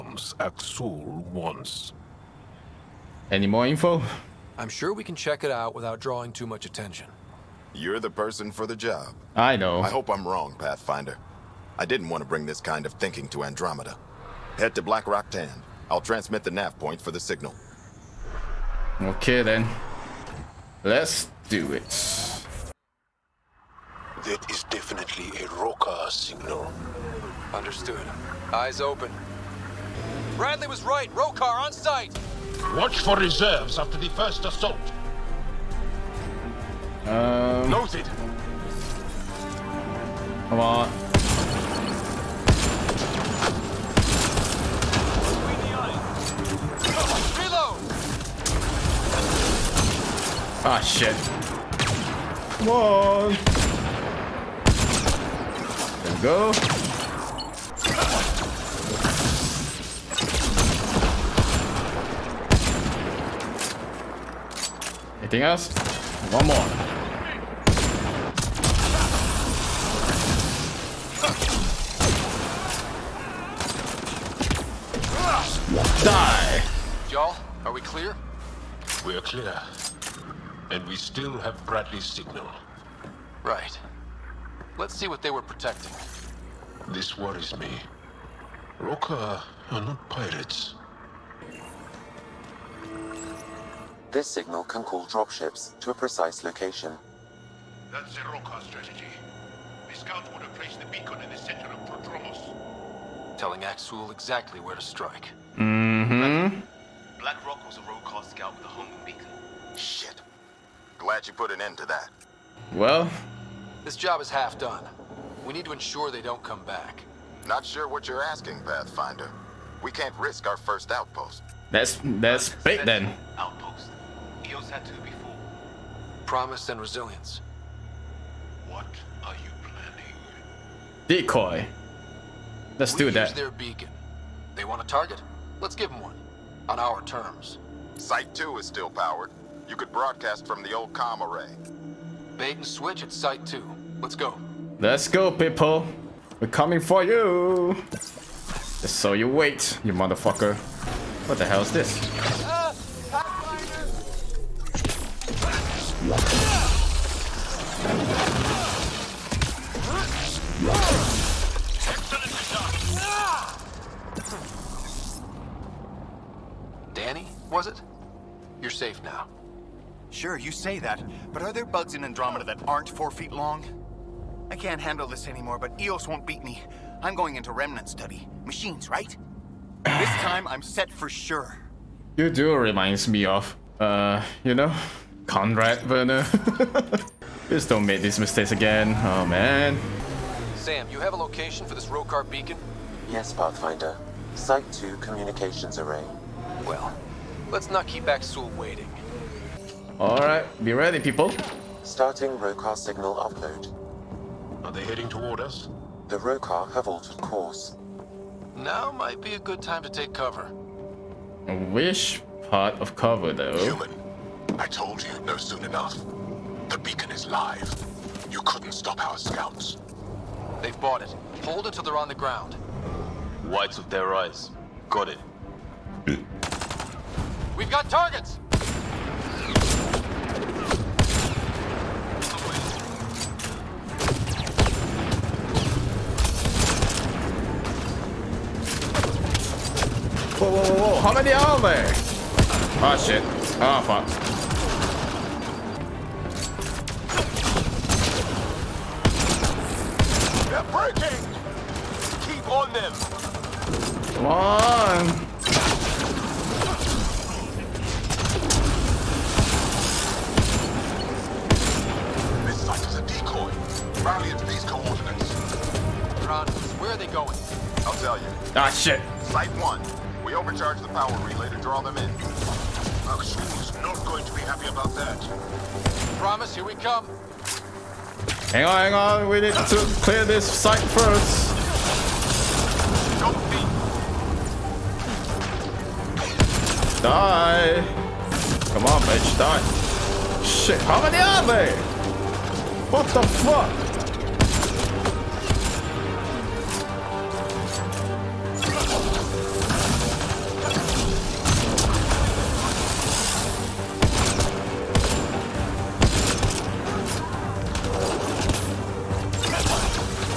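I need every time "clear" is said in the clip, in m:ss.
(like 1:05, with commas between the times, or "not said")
1:19, 4:40.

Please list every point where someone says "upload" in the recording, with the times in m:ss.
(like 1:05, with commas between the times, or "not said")
3:23.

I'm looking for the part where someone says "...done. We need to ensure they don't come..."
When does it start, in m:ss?
1:54.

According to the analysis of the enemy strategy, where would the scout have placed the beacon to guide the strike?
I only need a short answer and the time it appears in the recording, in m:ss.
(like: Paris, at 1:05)
Prodromos, at 1:41.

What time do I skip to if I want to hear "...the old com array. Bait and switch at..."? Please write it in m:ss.
2:20.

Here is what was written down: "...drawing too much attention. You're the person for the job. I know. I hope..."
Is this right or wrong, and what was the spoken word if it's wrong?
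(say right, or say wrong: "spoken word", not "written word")
right.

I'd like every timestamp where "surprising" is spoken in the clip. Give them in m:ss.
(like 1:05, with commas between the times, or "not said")
not said.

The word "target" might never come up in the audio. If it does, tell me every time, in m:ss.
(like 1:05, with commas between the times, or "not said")
2:14, 3:47.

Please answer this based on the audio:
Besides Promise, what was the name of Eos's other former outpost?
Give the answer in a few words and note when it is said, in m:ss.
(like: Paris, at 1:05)
Resilience, at 2:06.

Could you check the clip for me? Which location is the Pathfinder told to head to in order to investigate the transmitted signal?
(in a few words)
Black Rock Tan.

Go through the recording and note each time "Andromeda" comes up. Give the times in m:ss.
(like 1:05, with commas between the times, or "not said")
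0:13, 2:52.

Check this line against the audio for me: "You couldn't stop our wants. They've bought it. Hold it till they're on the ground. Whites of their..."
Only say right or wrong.
wrong.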